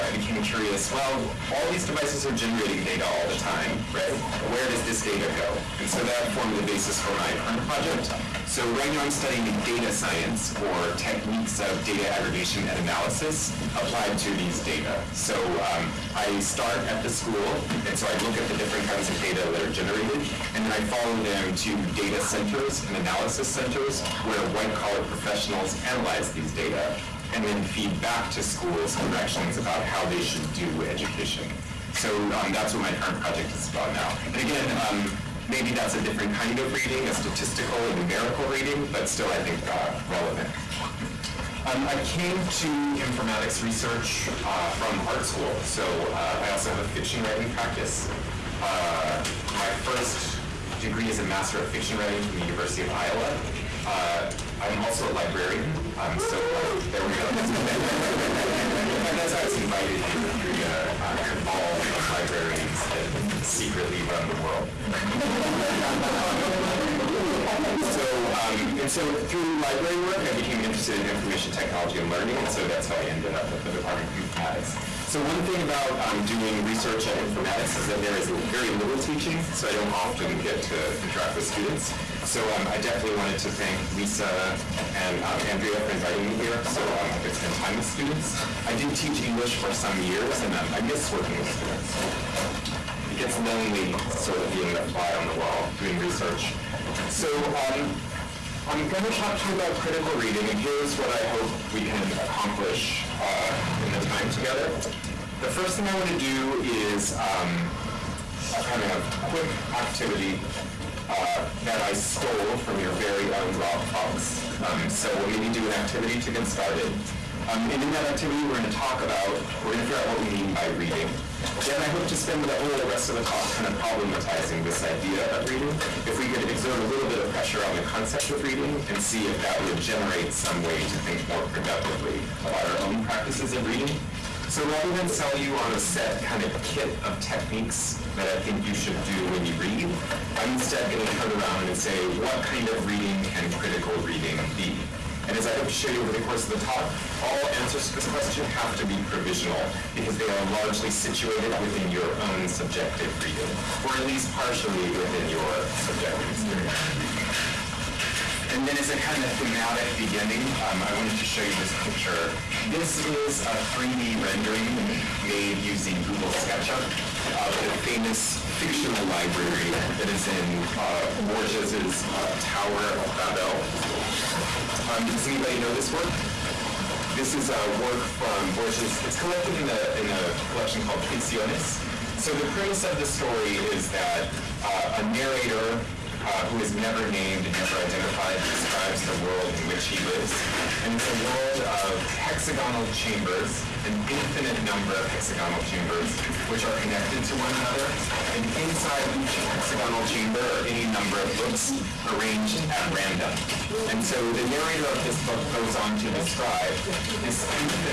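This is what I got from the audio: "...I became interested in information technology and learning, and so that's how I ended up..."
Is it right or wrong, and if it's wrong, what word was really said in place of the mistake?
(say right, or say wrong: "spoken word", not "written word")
right.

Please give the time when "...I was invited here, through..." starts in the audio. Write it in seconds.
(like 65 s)
59 s.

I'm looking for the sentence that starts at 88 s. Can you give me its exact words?
I did teach English for some years, and um, I miss working with students.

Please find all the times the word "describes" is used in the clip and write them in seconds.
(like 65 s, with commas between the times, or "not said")
188 s, 206 s.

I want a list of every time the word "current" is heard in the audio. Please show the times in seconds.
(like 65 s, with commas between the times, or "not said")
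7 s, 32 s.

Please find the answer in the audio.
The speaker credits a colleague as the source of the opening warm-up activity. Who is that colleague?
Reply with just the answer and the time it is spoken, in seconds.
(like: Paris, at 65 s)
Rob Fox, at 113 s.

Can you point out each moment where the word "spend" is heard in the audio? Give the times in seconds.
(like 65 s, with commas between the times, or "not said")
87 s, 122 s.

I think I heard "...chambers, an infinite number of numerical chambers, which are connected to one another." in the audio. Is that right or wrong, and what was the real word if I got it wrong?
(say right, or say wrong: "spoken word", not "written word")
wrong: "hexagonal", not "numerical".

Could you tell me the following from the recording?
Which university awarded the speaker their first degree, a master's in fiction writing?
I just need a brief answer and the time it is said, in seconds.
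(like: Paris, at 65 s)
University of Iowa, at 52 s.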